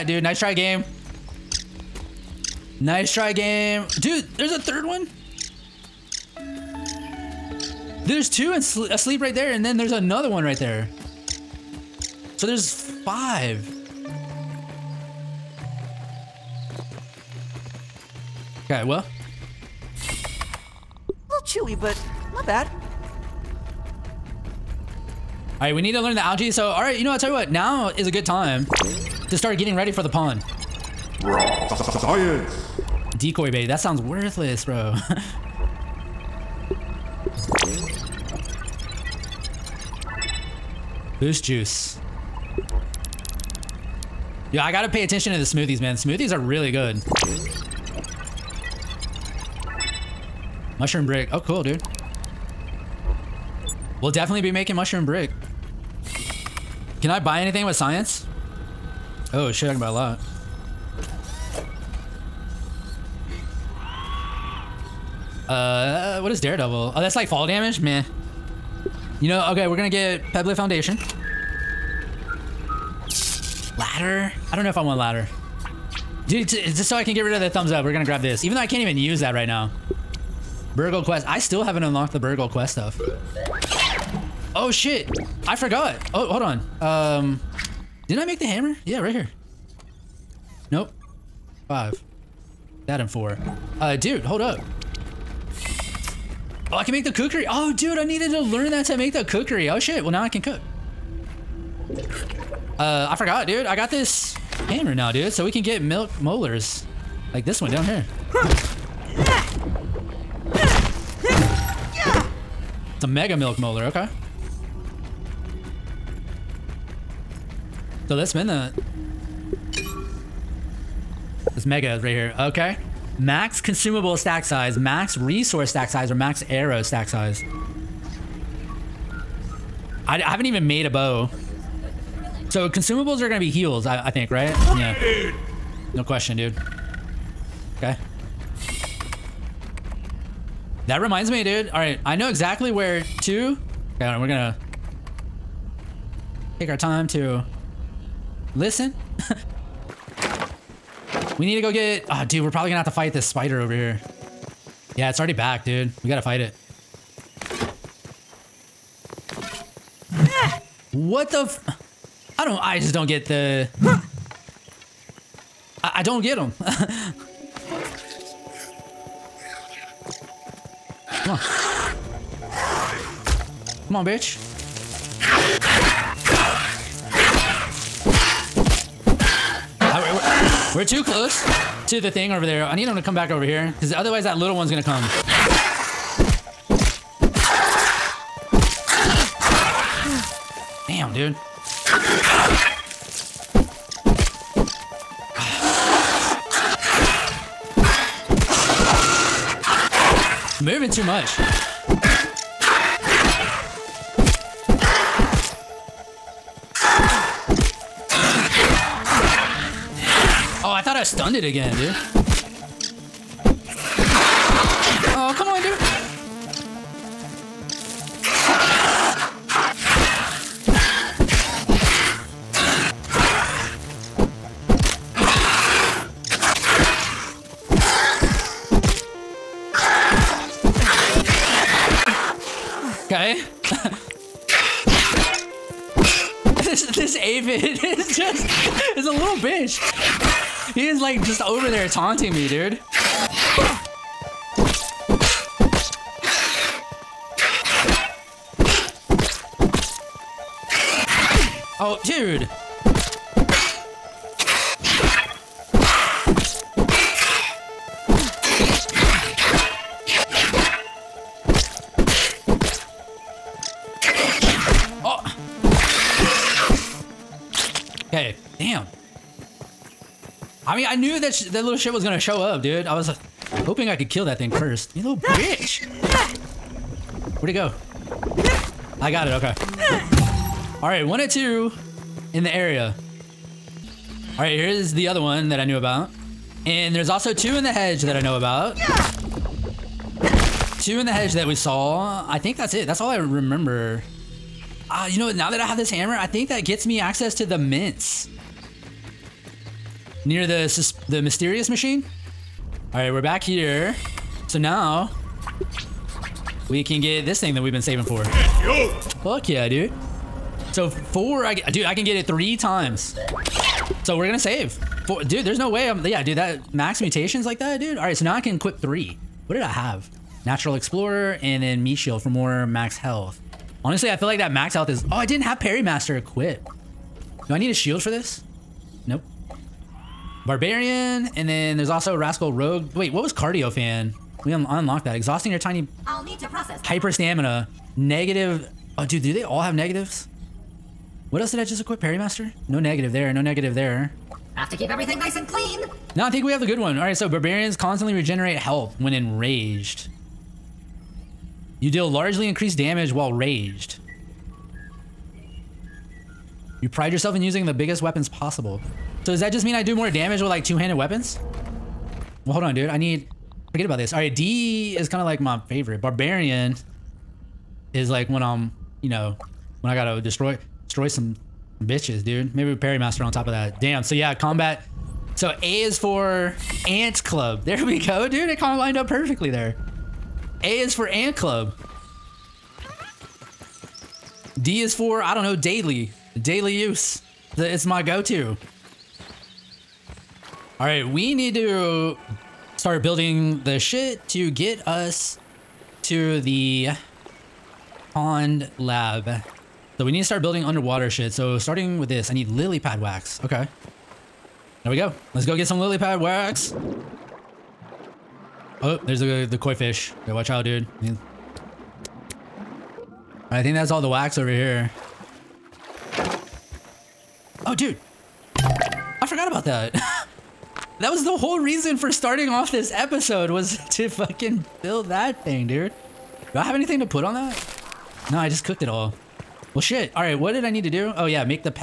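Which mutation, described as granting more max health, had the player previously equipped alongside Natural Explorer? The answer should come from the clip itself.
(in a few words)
Meat Shield.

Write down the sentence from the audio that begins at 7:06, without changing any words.
Do I have anything to put on that?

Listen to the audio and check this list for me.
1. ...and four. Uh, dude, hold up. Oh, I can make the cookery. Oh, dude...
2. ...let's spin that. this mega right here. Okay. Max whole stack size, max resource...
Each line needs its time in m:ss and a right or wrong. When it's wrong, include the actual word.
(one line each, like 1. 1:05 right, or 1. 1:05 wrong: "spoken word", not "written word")
1. 1:33 right
2. 1:58 wrong: "consumable", not "whole".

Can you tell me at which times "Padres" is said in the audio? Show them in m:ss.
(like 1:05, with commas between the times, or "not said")
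not said.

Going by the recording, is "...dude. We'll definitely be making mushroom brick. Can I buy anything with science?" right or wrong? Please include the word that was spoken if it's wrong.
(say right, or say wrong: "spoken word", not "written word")
right.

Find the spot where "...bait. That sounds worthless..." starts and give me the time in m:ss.
0:33.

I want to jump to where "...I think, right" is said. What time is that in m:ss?
2:14.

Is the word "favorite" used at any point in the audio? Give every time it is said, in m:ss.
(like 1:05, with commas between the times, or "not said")
6:05.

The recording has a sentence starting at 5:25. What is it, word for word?
Oh, I didn't have Parry Master equipped.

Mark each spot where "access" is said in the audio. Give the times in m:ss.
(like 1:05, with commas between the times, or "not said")
4:57.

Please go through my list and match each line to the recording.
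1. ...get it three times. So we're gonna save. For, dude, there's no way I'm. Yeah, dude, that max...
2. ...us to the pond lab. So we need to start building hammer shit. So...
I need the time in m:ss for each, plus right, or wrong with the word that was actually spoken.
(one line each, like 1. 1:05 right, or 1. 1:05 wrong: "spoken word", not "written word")
1. 5:12 right
2. 6:34 wrong: "underwater", not "hammer".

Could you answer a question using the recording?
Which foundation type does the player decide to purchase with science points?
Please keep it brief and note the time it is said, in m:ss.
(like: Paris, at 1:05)
Pebble Foundation, at 1:10.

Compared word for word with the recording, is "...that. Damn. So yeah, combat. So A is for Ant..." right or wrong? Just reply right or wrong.
right.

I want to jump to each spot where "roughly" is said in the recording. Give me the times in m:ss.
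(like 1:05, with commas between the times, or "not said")
not said.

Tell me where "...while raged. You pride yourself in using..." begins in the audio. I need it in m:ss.
5:53.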